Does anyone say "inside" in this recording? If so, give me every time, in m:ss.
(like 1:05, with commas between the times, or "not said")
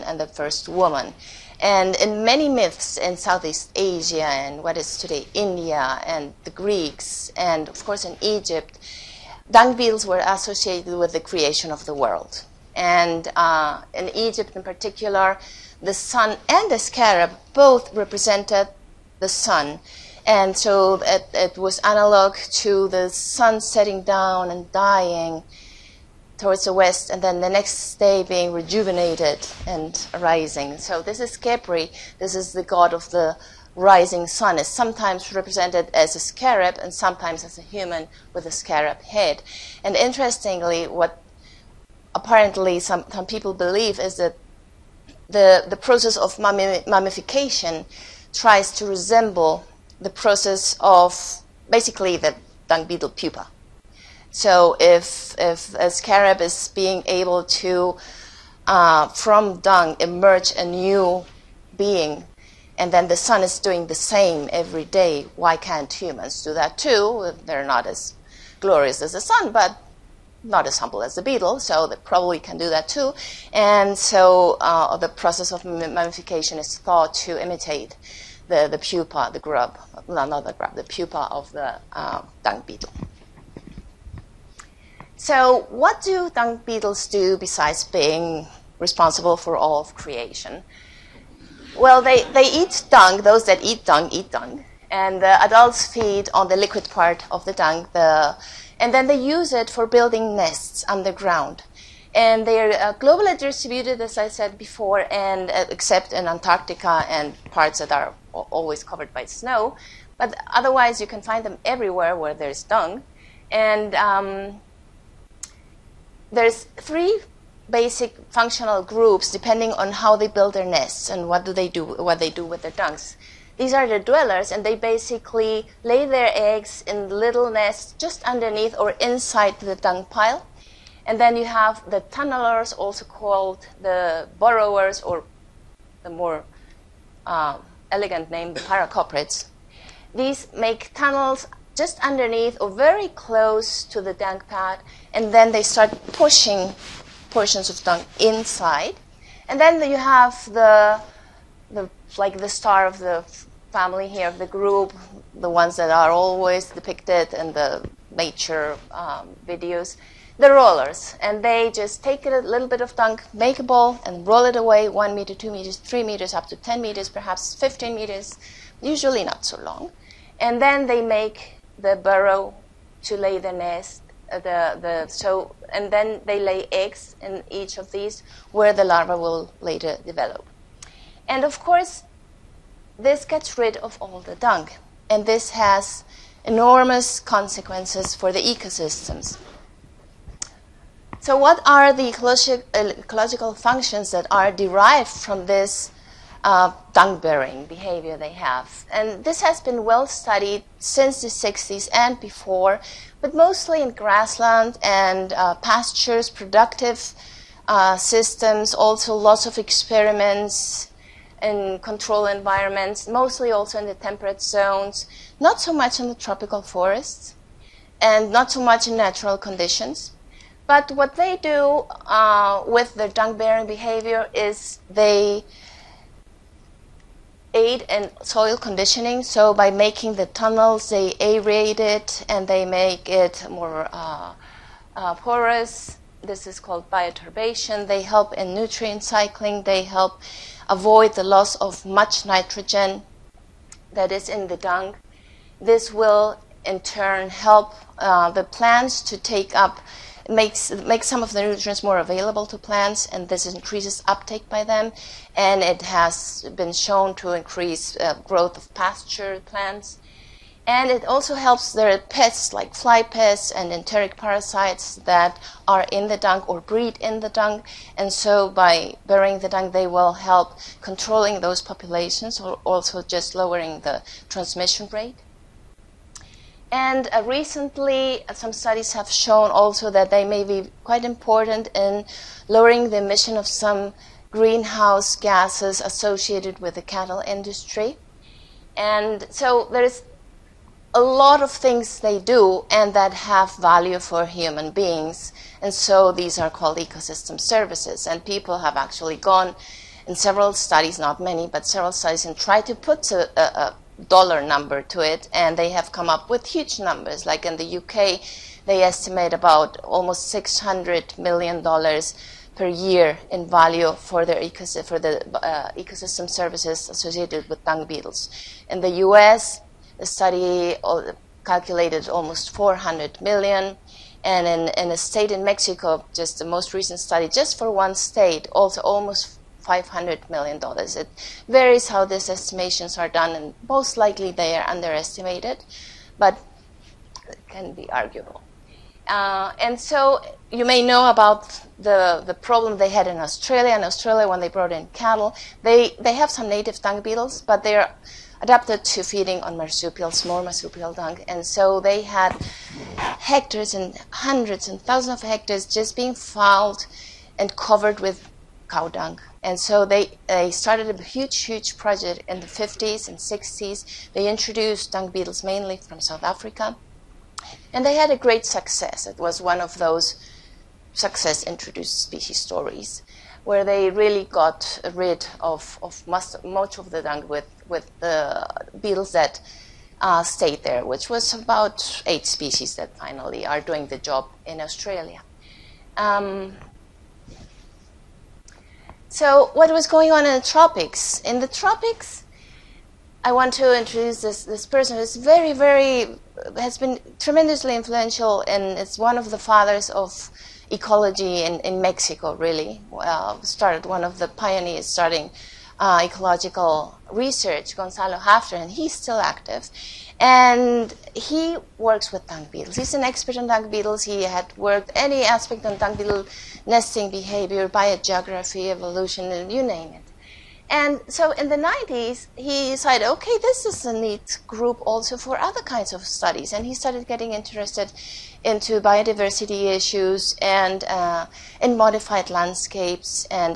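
2:08, 2:28.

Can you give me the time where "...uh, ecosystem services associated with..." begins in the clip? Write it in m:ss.
5:15.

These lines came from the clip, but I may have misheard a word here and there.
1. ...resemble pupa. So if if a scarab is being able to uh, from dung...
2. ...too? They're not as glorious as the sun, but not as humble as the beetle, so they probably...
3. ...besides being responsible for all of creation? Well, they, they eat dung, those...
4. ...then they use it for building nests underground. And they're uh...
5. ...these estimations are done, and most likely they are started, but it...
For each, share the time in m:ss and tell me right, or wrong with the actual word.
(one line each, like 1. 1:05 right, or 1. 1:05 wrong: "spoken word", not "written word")
1. 0:52 wrong: "beetle", not "resemble"
2. 1:06 right
3. 1:27 right
4. 1:38 right
5. 5:32 wrong: "underestimated", not "started".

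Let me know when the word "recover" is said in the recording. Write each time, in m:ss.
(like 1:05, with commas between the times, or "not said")
not said.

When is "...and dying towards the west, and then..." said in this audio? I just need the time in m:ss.
0:24.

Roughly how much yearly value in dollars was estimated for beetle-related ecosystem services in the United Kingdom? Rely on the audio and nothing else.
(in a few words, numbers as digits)
almost $600 million.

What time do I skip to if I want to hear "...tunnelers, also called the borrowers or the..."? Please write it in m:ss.
2:12.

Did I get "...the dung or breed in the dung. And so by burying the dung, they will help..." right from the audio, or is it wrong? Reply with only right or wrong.
right.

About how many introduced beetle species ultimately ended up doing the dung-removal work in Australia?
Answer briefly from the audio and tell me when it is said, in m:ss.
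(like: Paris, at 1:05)
8, at 6:22.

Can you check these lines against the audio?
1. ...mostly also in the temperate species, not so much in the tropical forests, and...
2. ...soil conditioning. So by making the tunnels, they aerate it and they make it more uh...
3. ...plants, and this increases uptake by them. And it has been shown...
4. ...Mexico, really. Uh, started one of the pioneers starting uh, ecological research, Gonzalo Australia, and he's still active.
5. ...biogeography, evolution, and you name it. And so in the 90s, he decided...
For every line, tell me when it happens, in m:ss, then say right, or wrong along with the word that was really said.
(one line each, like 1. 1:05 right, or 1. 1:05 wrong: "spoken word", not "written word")
1. 3:33 wrong: "zones", not "species"
2. 3:48 right
3. 4:12 right
4. 6:41 wrong: "Halffter", not "Australia"
5. 6:57 right.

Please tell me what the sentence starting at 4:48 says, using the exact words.
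And so there's a lot of things they do and that have value for human beings.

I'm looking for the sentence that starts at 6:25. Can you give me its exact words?
Um, so, what was going on in the tropics?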